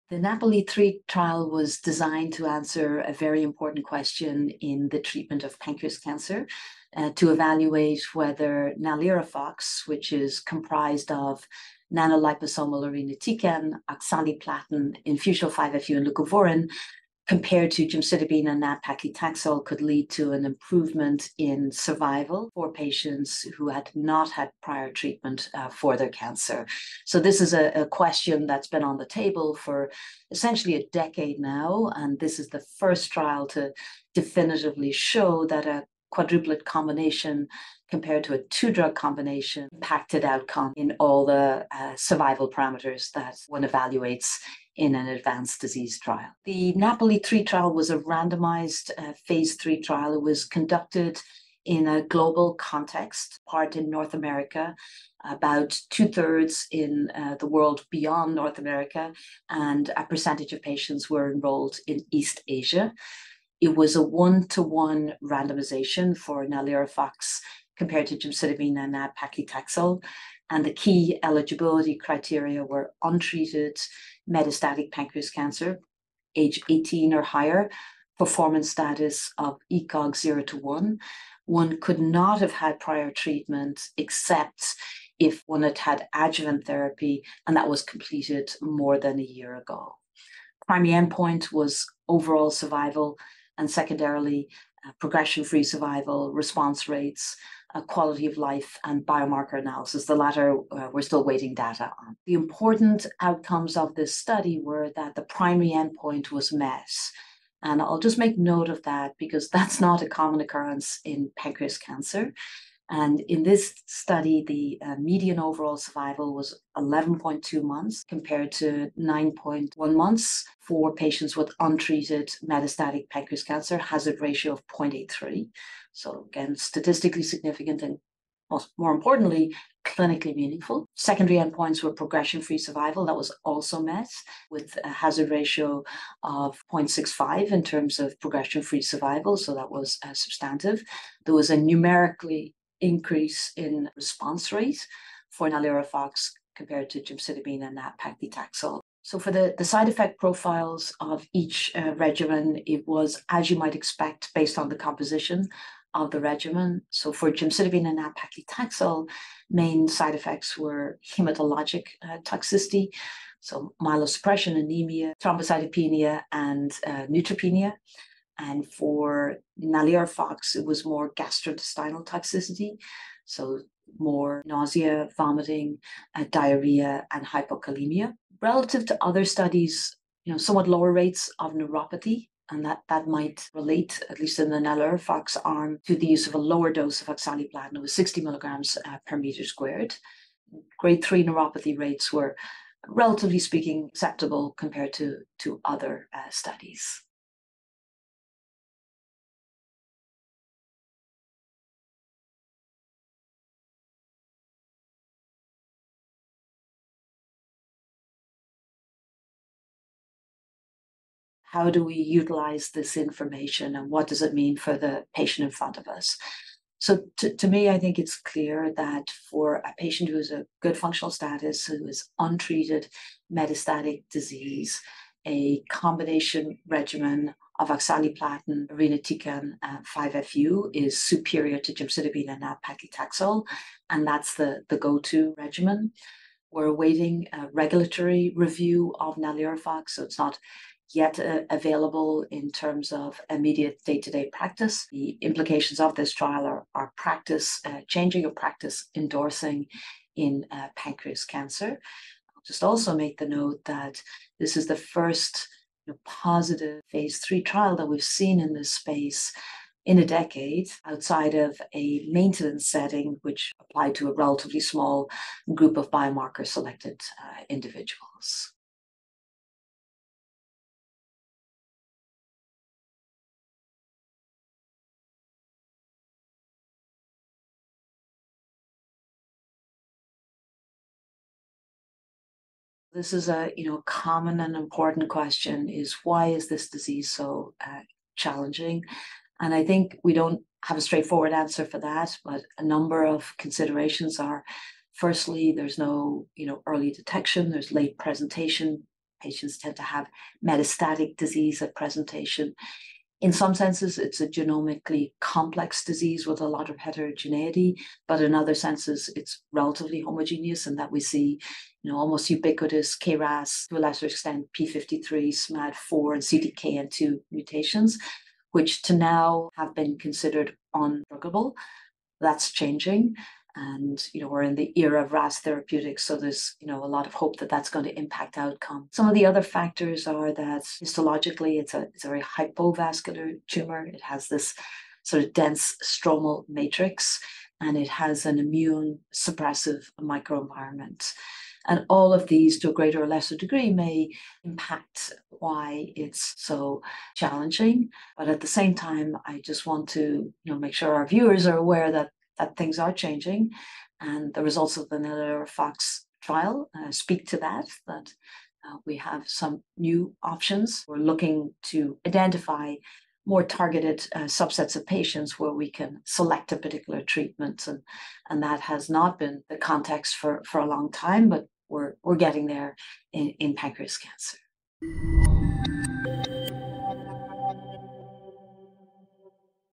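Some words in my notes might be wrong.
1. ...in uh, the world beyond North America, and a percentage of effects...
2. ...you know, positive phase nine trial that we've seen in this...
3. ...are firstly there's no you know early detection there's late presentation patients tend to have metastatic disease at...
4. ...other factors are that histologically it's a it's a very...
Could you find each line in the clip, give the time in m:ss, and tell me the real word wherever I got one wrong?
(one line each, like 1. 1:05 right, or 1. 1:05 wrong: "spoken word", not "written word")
1. 0:56 wrong: "patients", not "effects"
2. 4:15 wrong: "three", not "nine"
3. 4:54 right
4. 5:29 right.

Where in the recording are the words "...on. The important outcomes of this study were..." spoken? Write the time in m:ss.
1:42.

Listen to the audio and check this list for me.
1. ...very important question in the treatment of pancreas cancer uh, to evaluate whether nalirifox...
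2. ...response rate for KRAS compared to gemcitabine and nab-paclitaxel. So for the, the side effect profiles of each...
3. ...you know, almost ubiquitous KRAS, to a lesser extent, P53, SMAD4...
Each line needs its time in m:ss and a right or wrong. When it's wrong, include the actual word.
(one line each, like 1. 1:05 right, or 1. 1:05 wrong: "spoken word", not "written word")
1. 0:03 right
2. 2:23 wrong: "NALIRIFOX", not "KRAS"
3. 5:11 right.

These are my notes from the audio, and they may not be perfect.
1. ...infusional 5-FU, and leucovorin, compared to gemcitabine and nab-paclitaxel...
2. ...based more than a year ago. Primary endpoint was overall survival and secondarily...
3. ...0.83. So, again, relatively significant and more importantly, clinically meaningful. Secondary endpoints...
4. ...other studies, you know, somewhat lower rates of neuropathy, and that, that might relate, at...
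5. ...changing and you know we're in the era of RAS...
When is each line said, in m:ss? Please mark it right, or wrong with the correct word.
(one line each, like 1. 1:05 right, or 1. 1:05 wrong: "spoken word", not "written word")
1. 0:15 right
2. 1:27 wrong: "completed", not "based"
3. 2:04 wrong: "statistically", not "relatively"
4. 2:59 right
5. 5:22 right.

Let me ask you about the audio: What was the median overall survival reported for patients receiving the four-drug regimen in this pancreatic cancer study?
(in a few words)
11.2 months.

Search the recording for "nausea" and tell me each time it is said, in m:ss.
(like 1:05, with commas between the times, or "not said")
2:54.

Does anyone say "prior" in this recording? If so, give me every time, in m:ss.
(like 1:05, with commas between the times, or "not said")
0:24, 1:22.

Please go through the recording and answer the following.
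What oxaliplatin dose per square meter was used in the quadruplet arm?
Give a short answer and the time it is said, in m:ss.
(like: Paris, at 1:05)
60 milligrams, at 3:07.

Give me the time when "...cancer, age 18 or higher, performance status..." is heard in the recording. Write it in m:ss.
1:15.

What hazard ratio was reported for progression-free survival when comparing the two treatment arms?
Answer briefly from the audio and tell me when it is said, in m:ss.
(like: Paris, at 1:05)
0.65, at 2:16.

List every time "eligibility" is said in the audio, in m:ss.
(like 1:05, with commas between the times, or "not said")
1:11.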